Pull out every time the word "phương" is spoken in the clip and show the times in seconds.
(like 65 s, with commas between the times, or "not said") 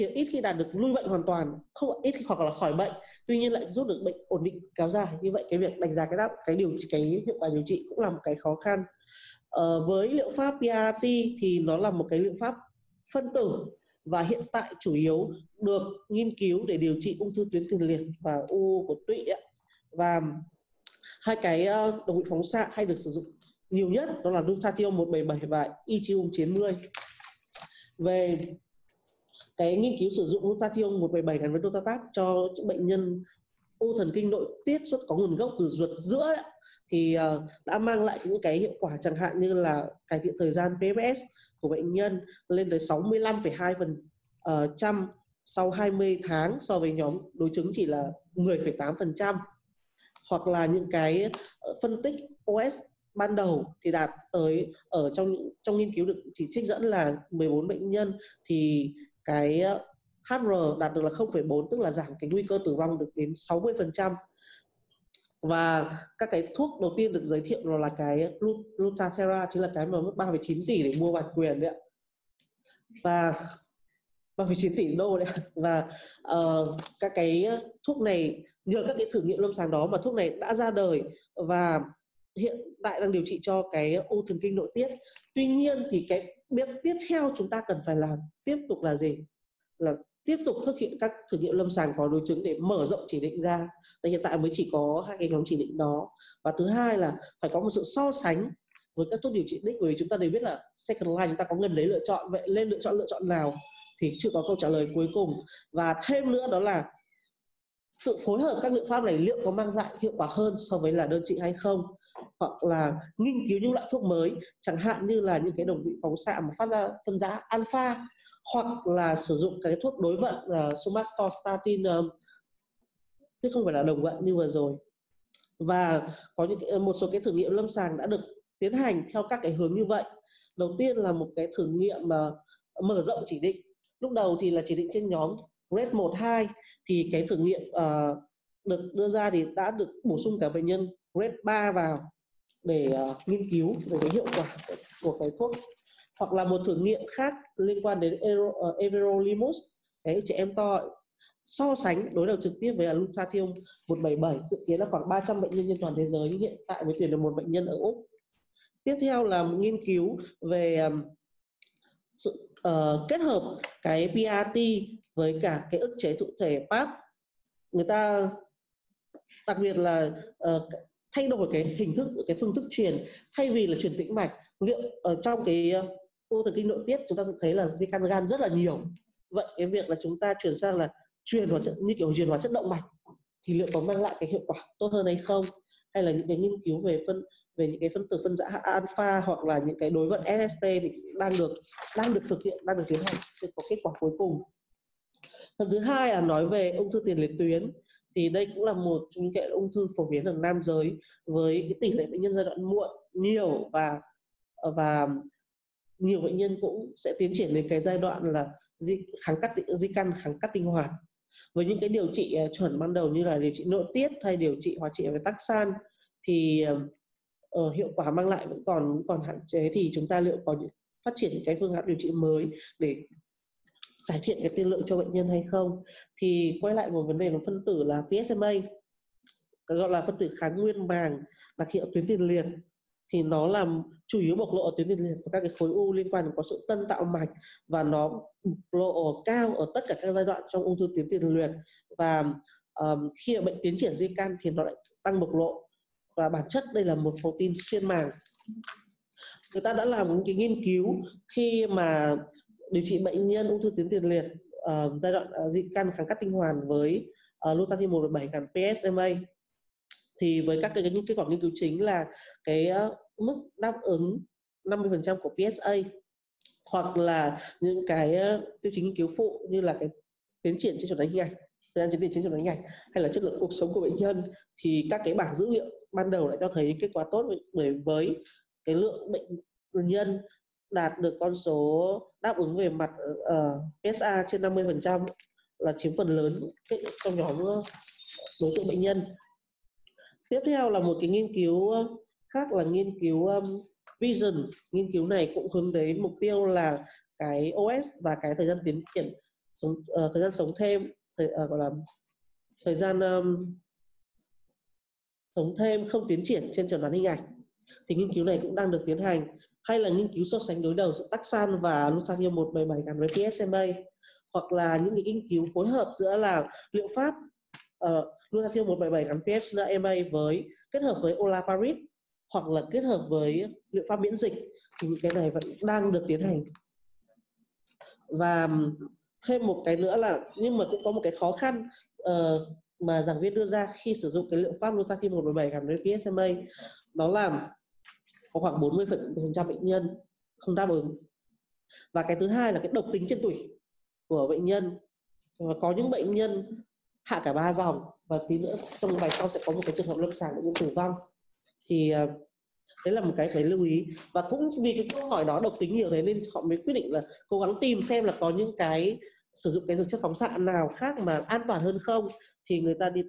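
172 s, 221 s.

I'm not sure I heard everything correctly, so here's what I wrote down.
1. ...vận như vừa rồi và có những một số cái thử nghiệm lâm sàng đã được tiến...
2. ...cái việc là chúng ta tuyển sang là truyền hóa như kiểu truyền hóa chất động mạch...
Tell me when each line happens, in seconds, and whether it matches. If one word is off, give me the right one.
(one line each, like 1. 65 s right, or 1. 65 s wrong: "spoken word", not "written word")
1. 124 s right
2. 179 s wrong: "chuyển", not "tuyển".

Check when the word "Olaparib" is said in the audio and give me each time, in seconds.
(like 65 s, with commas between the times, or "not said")
321 s.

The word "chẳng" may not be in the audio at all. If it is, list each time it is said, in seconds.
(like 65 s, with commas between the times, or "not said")
38 s, 114 s.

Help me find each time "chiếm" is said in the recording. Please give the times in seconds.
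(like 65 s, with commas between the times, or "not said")
285 s.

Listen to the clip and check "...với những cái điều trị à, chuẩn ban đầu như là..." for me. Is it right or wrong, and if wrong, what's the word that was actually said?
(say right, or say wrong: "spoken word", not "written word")
right.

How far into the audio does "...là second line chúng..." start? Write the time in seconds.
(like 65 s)
100 s.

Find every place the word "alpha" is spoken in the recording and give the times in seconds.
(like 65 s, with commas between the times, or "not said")
117 s, 188 s.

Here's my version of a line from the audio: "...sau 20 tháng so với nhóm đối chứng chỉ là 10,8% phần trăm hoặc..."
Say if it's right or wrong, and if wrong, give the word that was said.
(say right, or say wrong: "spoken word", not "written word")
right.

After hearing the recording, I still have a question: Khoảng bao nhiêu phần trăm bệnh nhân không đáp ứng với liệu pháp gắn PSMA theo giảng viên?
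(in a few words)
40%.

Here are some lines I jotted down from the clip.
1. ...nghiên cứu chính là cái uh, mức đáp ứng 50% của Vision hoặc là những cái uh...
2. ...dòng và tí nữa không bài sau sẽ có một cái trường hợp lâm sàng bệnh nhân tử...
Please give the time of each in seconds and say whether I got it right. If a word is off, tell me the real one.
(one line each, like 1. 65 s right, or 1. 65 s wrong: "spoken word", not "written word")
1. 261 s wrong: "PSA", not "Vision"
2. 347 s wrong: "trong", not "không".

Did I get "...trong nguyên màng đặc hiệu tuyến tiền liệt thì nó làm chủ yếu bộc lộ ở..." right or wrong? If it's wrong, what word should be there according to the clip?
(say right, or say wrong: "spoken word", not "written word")
wrong: "kháng", not "trong".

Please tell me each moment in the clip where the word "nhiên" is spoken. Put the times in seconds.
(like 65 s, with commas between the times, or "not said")
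3 s, 85 s.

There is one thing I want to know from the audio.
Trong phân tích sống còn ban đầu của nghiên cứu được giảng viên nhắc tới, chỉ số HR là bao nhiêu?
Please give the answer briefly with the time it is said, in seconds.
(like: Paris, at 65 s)
0,4, at 61 s.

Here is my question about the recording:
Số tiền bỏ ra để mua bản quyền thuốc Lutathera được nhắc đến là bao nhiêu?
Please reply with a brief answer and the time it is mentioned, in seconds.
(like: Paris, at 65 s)
3,9 tỷ đô, at 74 s.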